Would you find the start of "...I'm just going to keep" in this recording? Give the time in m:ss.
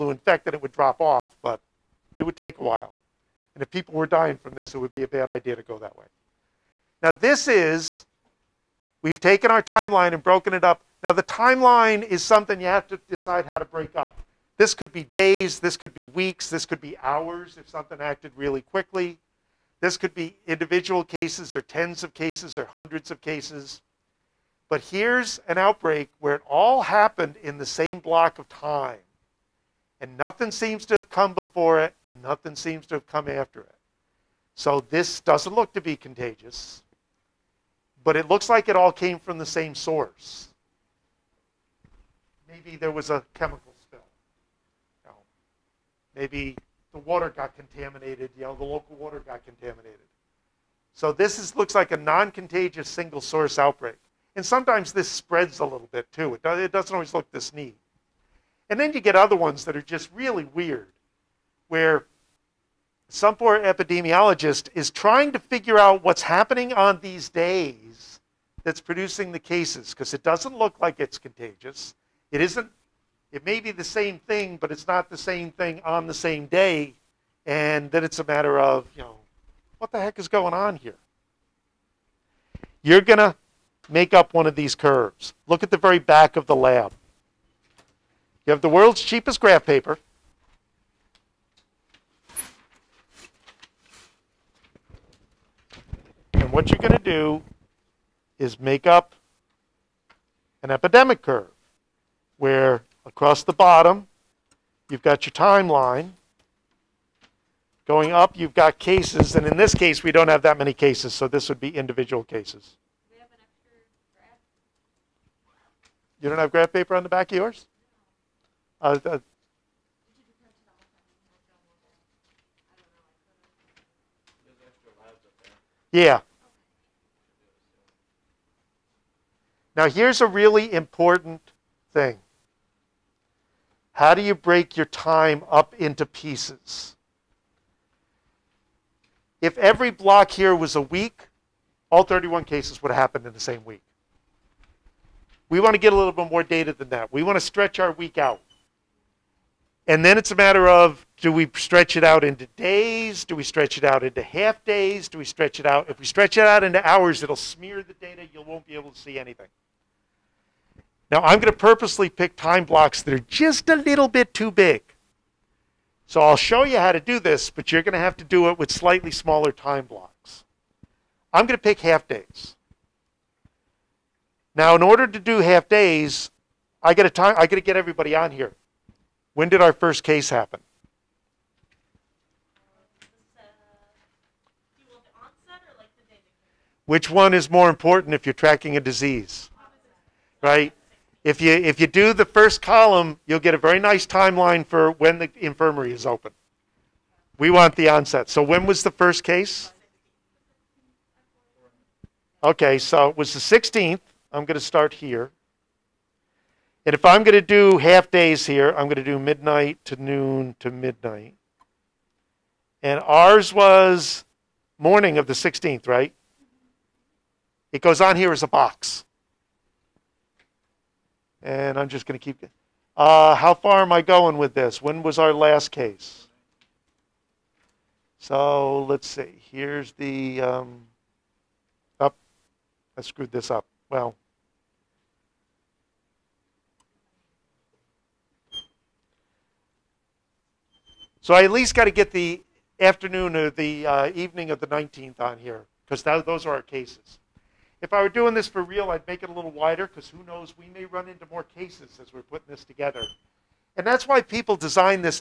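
3:41.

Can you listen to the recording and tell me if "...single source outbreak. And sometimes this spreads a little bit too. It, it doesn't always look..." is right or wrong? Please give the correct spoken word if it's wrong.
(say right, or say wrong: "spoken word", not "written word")
right.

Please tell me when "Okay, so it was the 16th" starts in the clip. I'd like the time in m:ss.
3:22.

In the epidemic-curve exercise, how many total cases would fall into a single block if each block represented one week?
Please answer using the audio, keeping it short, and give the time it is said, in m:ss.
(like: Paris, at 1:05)
31, at 2:22.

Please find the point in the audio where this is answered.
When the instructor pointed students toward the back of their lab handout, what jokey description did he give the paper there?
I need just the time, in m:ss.
1:28.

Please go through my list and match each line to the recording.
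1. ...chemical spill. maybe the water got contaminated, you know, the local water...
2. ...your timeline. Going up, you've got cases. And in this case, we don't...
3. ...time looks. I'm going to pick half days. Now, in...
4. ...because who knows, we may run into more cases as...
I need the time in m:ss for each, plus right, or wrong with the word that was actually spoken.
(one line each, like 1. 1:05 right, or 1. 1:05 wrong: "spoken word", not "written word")
1. 0:43 right
2. 1:45 right
3. 2:49 wrong: "blocks", not "looks"
4. 4:09 right.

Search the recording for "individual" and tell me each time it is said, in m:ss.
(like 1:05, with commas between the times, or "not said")
0:20, 1:51.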